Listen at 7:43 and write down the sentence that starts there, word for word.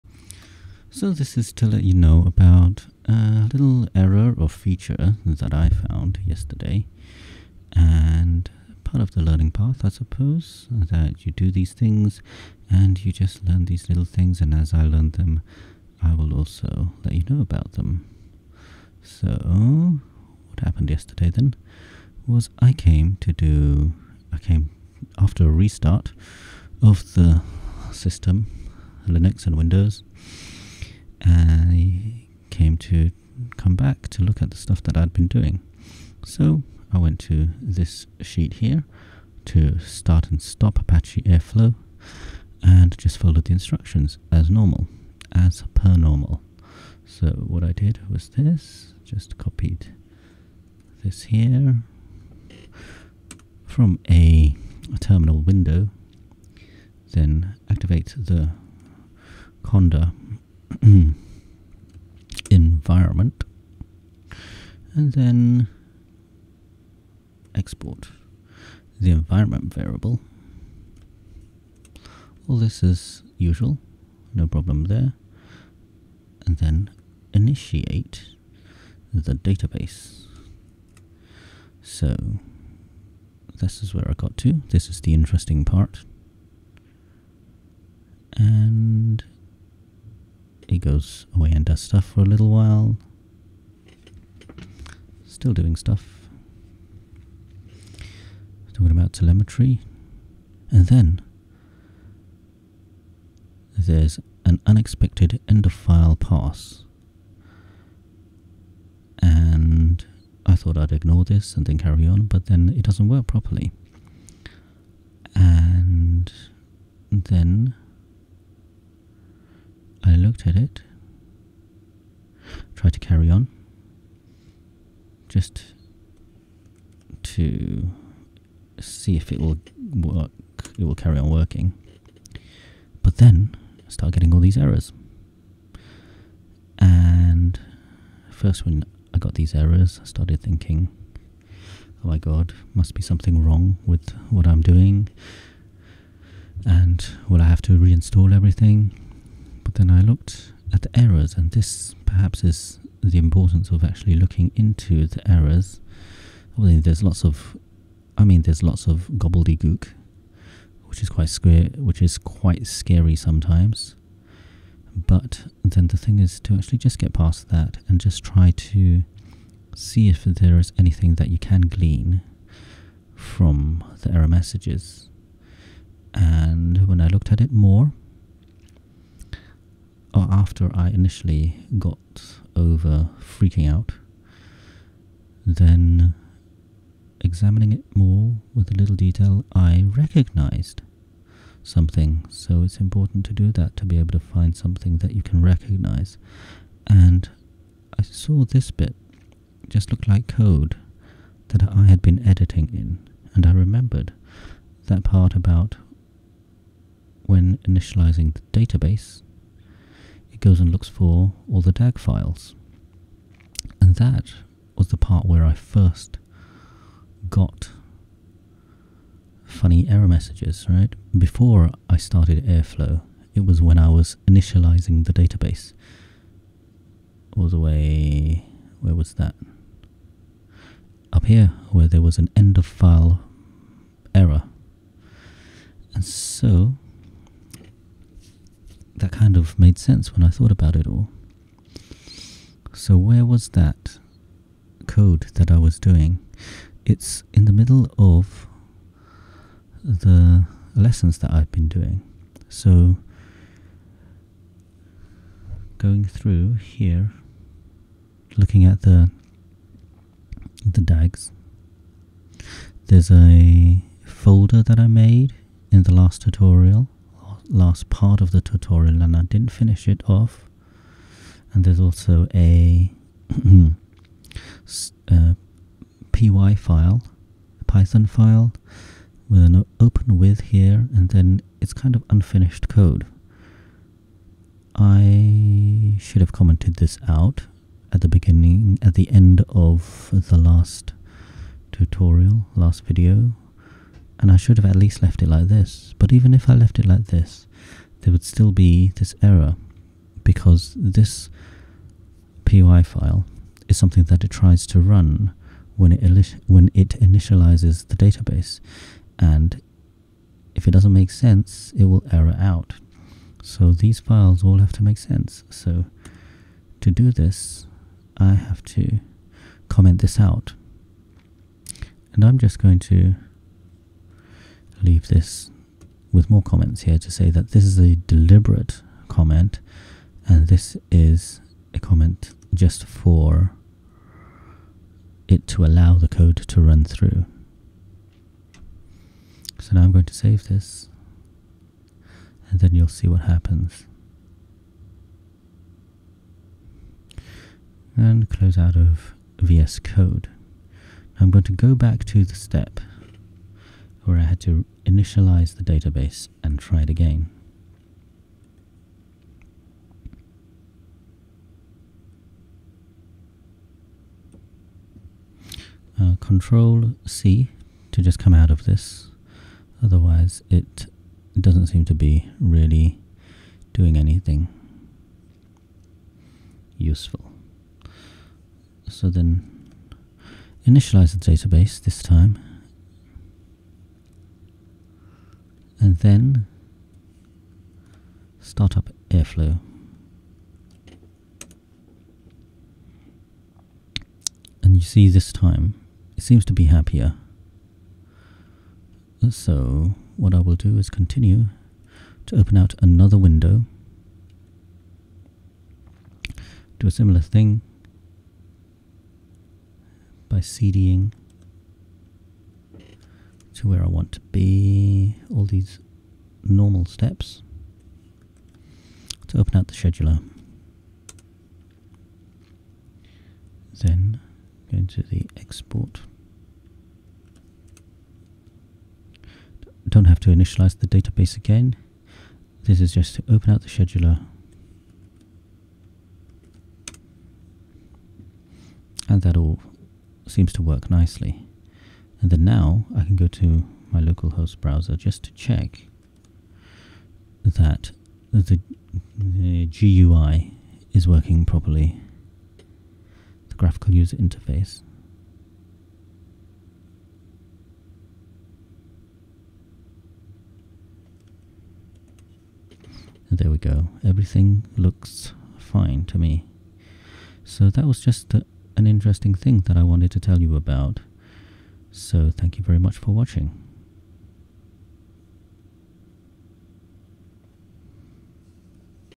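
And there we go, everything looks fine to me.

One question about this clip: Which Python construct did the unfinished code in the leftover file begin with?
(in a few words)
open with.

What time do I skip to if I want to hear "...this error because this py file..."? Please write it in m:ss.
4:58.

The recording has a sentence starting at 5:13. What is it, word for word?
So these files all have to make sense.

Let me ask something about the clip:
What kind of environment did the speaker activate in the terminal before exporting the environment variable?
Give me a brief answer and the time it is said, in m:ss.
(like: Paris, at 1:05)
conda, at 0:59.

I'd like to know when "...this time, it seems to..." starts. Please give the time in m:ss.
6:35.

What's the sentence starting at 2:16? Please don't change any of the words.
And first, when I got these errors, I started thinking, oh my god, must be something wrong with what I'm doing.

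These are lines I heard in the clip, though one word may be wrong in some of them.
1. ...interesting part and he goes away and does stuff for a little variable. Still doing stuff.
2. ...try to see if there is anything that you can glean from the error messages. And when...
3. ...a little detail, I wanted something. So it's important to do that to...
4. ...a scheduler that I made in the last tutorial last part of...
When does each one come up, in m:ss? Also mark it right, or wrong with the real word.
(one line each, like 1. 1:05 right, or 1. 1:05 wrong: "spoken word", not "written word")
1. 1:25 wrong: "while", not "variable"
2. 2:48 right
3. 3:08 wrong: "recognized", not "wanted"
4. 4:23 wrong: "folder", not "scheduler".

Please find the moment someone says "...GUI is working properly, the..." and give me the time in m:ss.
7:29.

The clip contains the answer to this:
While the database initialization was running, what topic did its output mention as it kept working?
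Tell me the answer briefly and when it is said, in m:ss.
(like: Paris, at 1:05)
telemetry, at 1:39.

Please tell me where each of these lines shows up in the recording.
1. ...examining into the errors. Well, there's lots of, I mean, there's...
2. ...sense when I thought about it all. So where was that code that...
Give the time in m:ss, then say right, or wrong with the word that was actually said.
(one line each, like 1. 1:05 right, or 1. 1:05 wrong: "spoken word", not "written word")
1. 2:34 wrong: "looking", not "examining"
2. 3:59 right.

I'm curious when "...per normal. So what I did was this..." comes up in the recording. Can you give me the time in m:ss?
0:45.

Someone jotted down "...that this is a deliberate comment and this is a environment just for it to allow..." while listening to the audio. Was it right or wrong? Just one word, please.
wrong.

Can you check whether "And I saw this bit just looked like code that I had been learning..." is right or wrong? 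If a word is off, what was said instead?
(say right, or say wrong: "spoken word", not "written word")
wrong: "editing", not "learning".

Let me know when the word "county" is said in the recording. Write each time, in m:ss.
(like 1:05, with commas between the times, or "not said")
not said.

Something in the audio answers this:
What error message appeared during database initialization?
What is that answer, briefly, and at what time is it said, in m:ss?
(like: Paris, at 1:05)
unexpected end of file, at 1:44.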